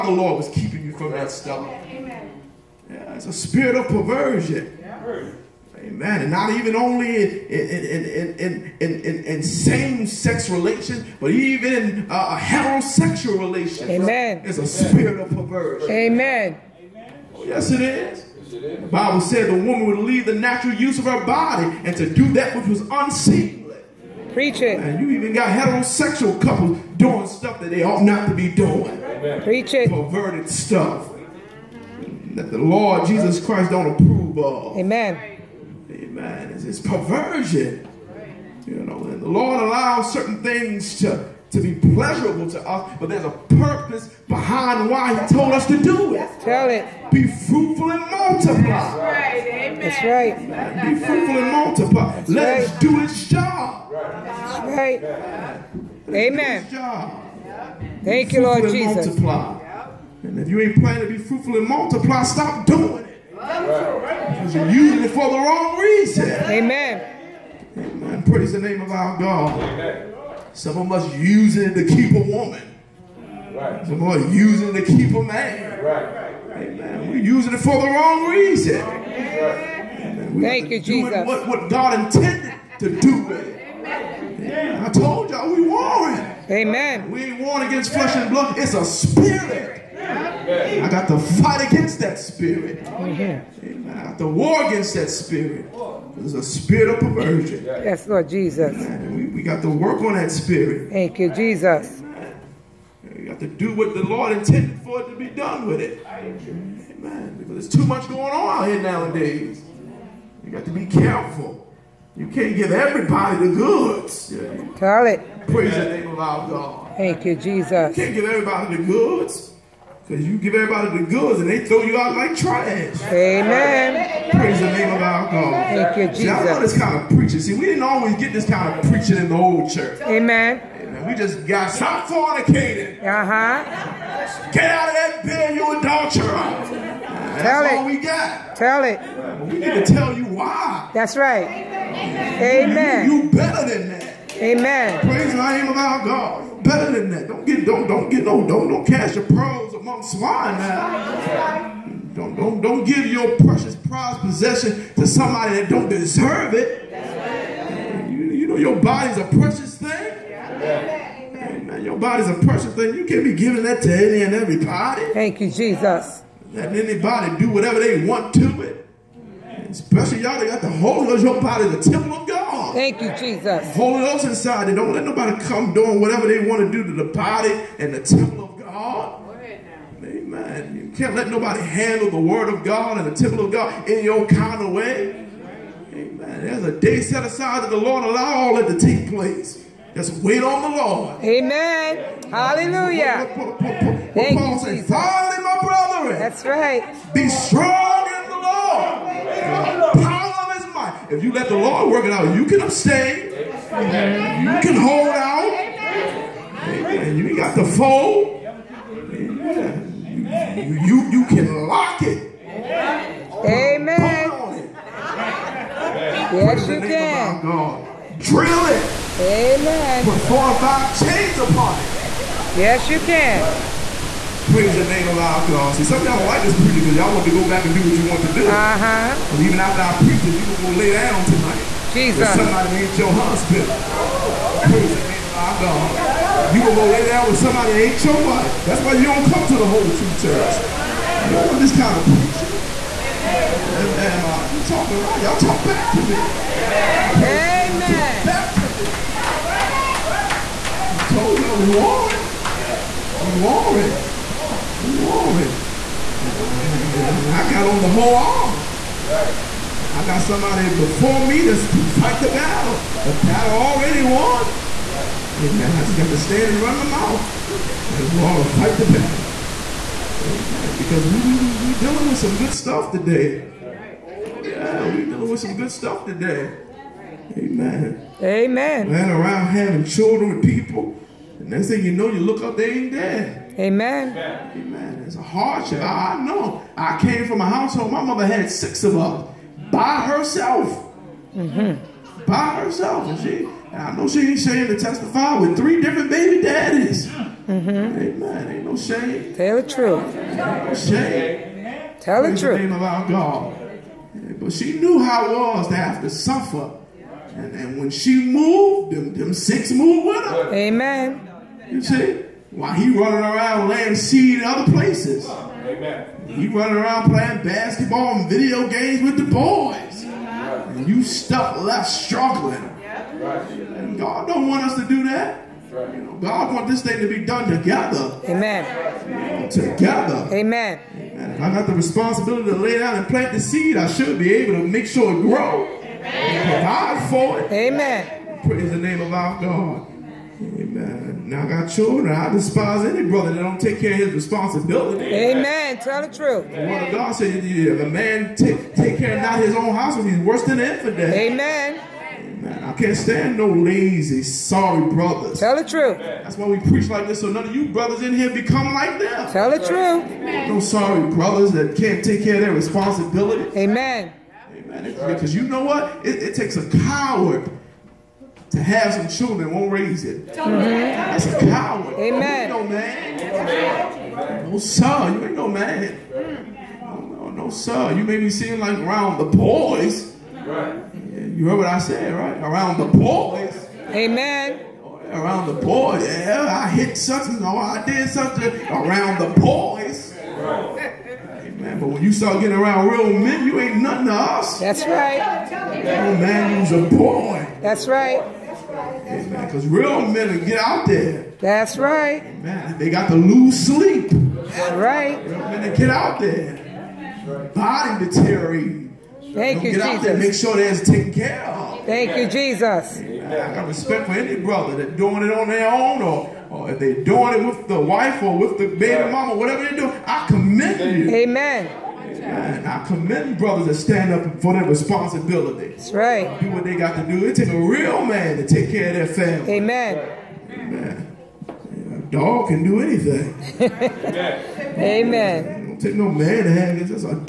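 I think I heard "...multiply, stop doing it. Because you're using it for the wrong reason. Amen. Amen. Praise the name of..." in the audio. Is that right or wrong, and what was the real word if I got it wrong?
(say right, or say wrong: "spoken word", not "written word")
right.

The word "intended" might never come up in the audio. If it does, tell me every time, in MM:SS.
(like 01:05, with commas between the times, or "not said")
01:22, 01:44.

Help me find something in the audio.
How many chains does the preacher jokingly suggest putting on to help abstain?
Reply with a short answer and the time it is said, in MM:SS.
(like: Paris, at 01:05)
4 or 5, at 03:40.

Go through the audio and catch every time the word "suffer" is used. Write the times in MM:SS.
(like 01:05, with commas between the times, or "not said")
05:06.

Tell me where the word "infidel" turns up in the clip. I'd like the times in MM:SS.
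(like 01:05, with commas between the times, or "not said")
05:50.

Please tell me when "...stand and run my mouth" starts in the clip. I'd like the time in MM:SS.
04:26.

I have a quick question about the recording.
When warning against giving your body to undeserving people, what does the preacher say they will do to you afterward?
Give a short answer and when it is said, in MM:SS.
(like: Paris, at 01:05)
Throw you out like trash, at 02:01.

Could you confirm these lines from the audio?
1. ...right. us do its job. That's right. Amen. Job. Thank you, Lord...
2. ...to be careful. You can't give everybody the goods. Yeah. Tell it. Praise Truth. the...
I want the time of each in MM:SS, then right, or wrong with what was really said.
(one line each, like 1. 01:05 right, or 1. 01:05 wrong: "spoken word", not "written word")
1. 00:52 right
2. 01:50 wrong: "Amen", not "Truth".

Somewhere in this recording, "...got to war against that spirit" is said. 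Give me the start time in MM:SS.
01:34.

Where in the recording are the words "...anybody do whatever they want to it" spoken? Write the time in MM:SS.
02:46.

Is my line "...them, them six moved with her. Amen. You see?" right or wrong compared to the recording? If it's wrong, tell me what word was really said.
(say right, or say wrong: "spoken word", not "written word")
right.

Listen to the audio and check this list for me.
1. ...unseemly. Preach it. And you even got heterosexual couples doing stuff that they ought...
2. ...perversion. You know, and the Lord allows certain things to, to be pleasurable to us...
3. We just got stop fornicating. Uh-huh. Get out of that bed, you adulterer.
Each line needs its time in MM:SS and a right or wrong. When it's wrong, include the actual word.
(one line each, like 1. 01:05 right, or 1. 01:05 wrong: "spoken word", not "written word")
1. 00:22 right
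2. 00:36 right
3. 02:11 right.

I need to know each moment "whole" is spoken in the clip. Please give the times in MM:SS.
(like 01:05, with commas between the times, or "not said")
03:59, 04:17.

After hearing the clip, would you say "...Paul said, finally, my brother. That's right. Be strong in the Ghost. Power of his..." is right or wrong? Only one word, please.
wrong.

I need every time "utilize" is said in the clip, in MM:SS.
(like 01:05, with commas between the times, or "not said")
not said.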